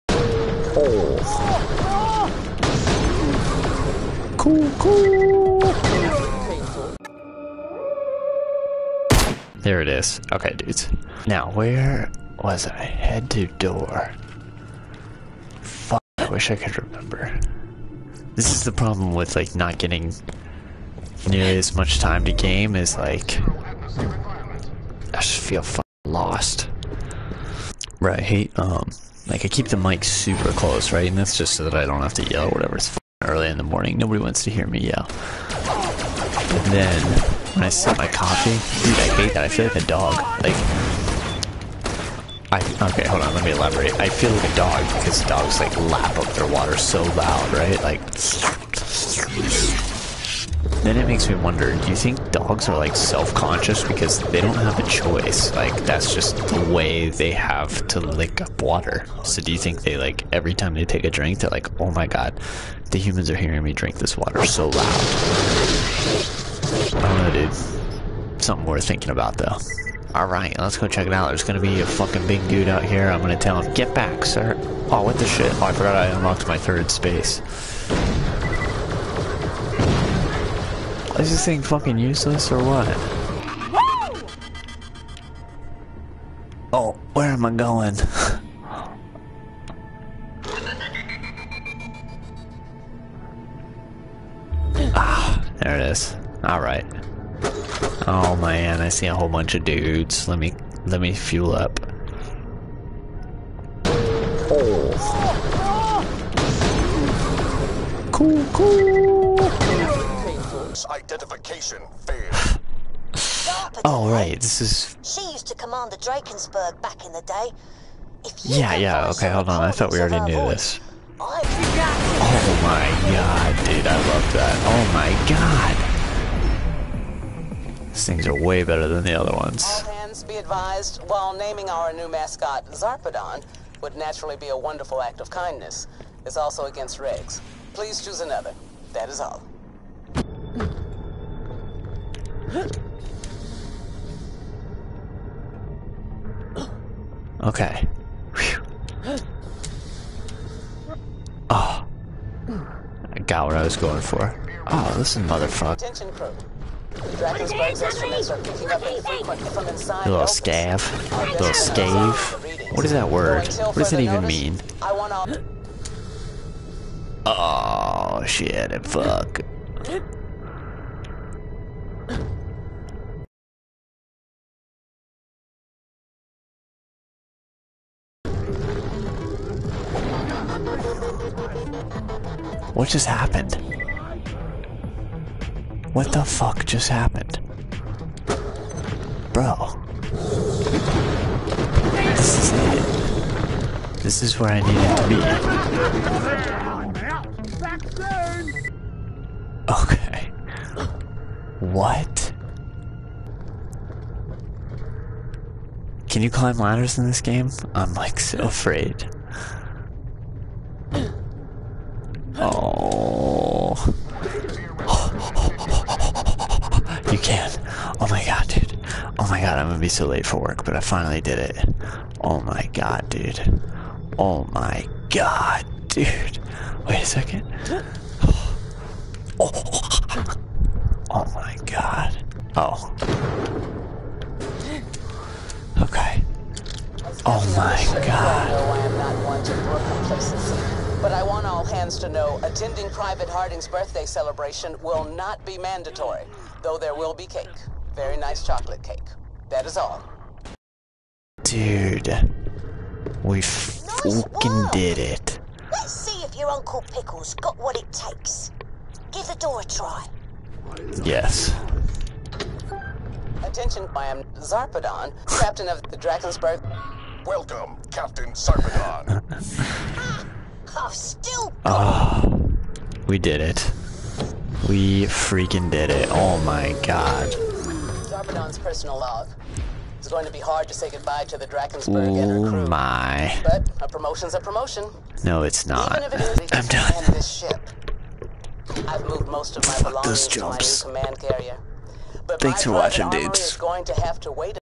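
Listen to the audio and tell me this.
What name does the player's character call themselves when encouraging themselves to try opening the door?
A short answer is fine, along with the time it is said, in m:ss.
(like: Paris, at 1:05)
Uncle Pickles, at 4:16.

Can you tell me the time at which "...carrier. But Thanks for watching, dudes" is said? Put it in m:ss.
4:51.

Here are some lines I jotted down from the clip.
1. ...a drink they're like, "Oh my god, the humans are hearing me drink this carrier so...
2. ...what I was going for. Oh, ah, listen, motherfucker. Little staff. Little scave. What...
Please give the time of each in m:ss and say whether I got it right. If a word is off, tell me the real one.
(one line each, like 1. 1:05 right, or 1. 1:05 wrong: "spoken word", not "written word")
1. 1:01 wrong: "water", not "carrier"
2. 2:33 right.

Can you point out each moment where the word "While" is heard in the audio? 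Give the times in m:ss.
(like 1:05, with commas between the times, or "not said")
2:11.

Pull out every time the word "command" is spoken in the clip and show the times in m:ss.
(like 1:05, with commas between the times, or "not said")
1:55, 4:51.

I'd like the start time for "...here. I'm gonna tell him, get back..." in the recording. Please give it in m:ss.
1:12.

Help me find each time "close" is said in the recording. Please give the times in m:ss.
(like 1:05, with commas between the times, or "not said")
0:30.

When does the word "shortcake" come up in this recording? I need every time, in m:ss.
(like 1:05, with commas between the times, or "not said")
not said.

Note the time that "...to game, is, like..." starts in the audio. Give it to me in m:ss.
0:22.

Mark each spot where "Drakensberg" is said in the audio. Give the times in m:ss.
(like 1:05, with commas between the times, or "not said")
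1:55, 4:25, 4:41.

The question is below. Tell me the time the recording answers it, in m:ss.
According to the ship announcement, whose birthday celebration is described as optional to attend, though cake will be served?
4:02.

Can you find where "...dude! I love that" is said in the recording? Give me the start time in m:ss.
2:03.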